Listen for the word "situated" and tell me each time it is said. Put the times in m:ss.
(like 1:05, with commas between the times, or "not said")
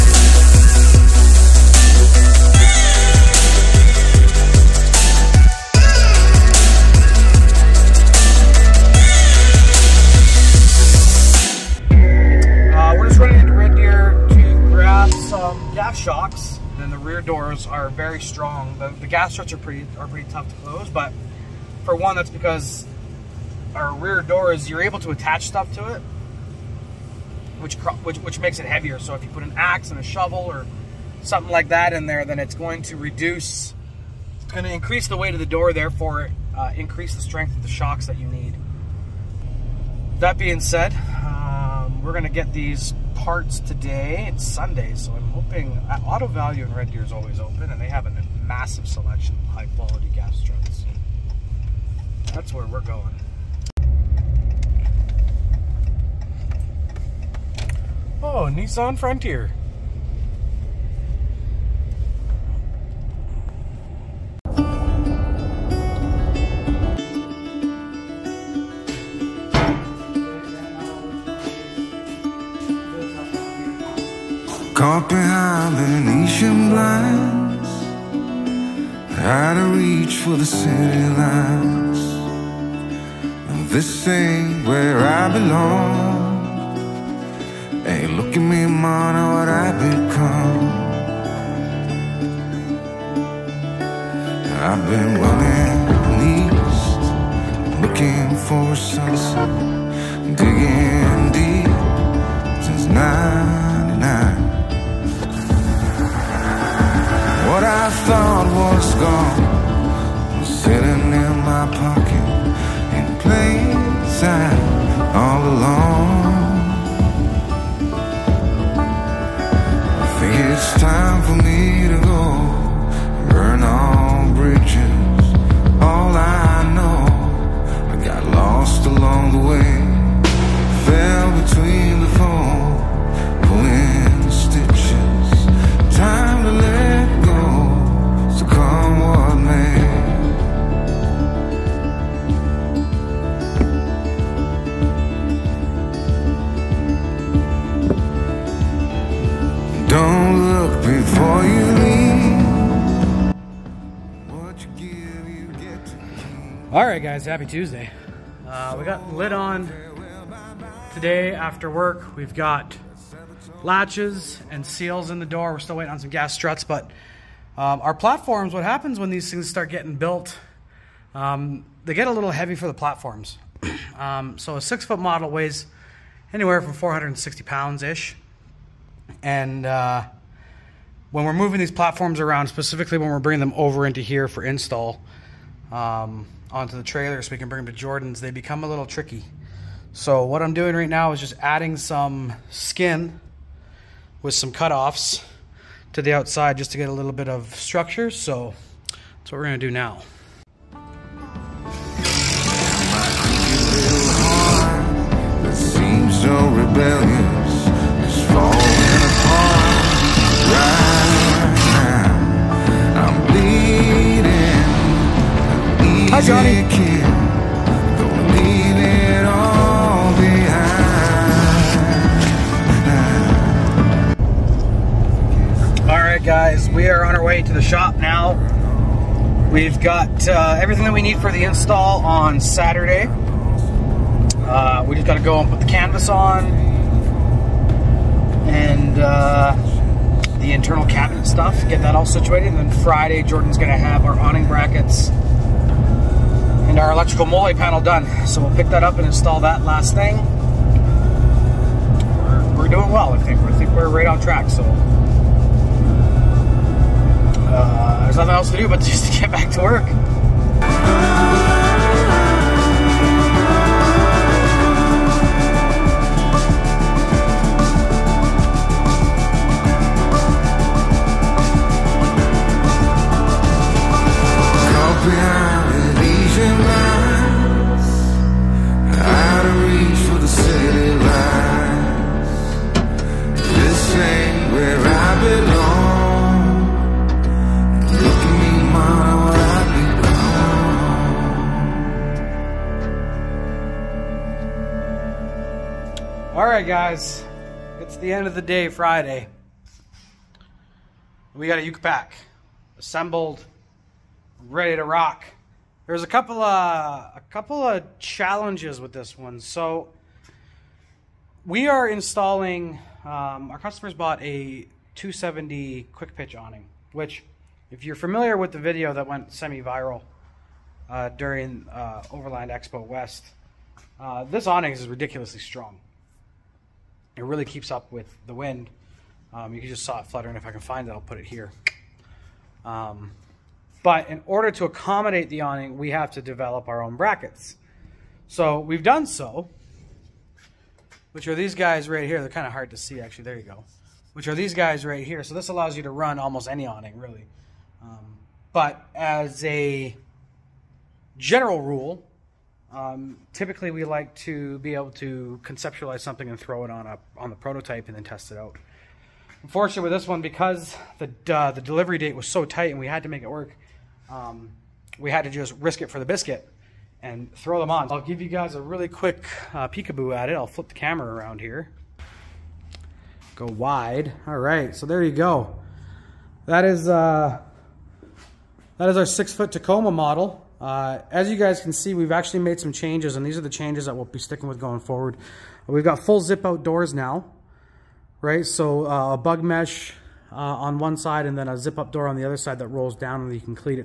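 4:02.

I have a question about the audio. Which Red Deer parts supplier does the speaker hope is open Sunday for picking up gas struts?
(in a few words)
Auto Value.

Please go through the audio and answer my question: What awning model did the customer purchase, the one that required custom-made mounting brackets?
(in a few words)
270 quick pitch.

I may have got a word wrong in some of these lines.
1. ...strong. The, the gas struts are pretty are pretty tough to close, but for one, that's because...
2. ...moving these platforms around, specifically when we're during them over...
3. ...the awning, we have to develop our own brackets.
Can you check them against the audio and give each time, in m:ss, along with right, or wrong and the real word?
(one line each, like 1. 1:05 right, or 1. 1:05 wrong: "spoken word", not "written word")
1. 0:18 right
2. 3:01 wrong: "bringing", not "during"
3. 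5:35 right.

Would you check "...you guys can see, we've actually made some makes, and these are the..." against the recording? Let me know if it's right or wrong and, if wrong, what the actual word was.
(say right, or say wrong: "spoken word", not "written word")
wrong: "changes", not "makes".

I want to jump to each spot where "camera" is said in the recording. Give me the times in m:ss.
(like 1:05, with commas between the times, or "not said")
6:10.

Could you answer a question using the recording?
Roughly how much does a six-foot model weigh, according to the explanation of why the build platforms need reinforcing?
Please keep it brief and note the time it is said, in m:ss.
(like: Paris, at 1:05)
460 pounds, at 2:56.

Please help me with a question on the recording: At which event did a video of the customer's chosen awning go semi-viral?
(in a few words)
Overland Expo West.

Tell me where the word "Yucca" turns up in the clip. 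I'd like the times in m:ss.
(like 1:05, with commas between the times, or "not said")
5:01.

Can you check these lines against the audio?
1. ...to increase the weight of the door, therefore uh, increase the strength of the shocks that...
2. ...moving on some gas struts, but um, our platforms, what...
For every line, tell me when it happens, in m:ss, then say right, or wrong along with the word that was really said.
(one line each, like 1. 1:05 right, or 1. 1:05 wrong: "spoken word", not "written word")
1. 0:34 right
2. 2:45 wrong: "waiting", not "moving".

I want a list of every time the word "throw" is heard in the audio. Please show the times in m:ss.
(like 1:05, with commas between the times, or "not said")
5:56, 6:07.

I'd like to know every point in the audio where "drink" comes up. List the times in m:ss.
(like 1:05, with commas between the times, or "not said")
not said.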